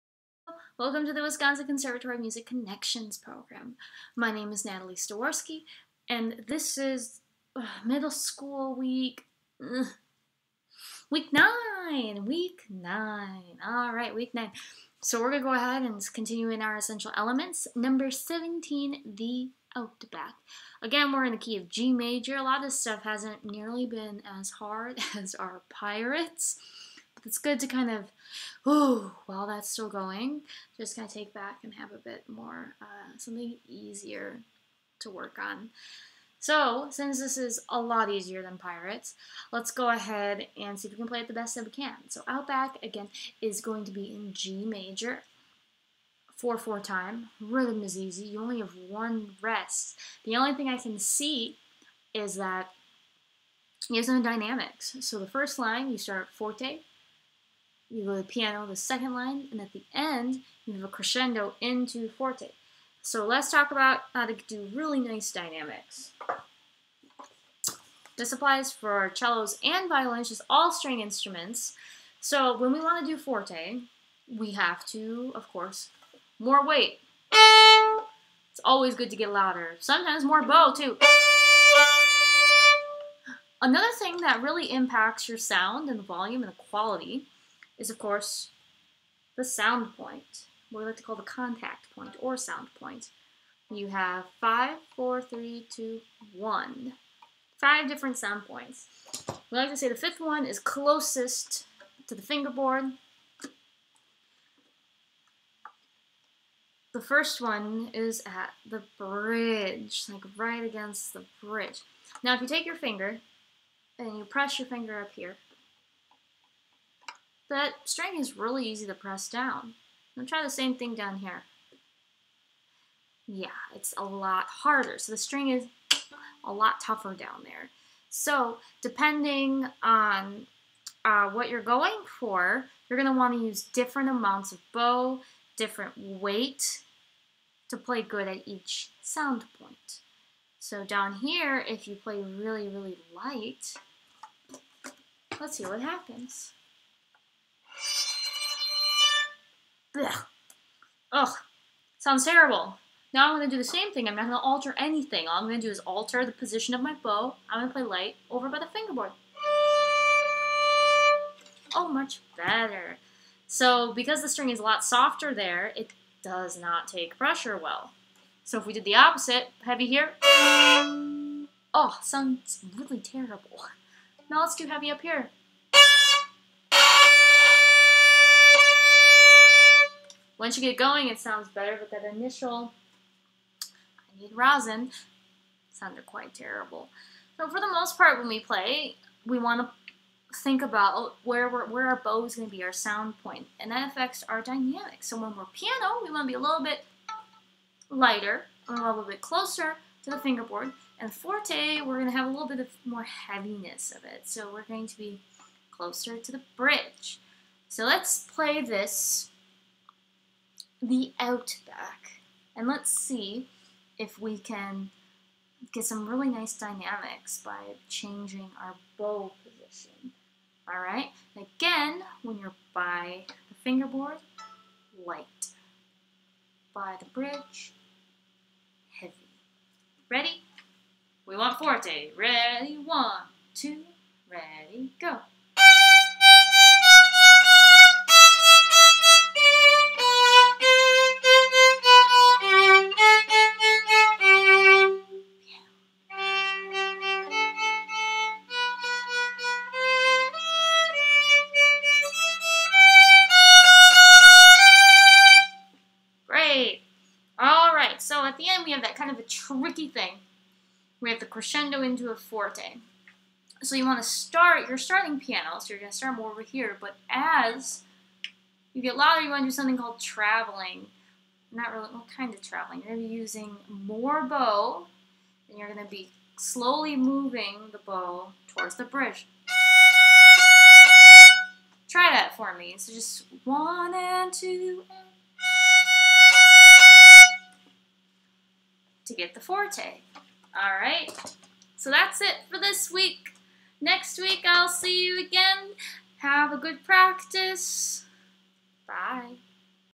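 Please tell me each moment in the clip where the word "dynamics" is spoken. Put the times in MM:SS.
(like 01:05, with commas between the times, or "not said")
00:54, 01:05, 03:14, 03:36.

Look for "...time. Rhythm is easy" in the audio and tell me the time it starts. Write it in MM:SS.
00:46.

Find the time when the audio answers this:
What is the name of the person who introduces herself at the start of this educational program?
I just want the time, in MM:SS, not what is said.
00:04.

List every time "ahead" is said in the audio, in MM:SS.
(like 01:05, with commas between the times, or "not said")
00:15, 00:39.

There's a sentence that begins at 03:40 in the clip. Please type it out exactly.
All right, again, when you're by the fingerboard, light.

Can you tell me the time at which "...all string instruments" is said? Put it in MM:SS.
01:10.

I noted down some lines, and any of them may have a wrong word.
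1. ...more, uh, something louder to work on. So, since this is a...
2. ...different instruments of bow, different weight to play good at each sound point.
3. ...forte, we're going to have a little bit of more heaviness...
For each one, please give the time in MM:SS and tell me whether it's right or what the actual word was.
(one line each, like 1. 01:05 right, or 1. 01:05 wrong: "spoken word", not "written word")
1. 00:32 wrong: "easier", not "louder"
2. 02:13 wrong: "amounts", not "instruments"
3. 03:21 right.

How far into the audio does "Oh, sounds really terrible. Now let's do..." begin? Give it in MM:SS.
02:51.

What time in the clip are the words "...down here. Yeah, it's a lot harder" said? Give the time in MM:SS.
02:00.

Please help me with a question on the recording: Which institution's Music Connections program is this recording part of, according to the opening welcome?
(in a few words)
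Wisconsin Conservatory.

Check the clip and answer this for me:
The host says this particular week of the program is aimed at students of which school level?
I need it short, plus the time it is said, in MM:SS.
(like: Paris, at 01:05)
Middle school, at 00:07.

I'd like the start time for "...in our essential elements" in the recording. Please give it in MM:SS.
00:16.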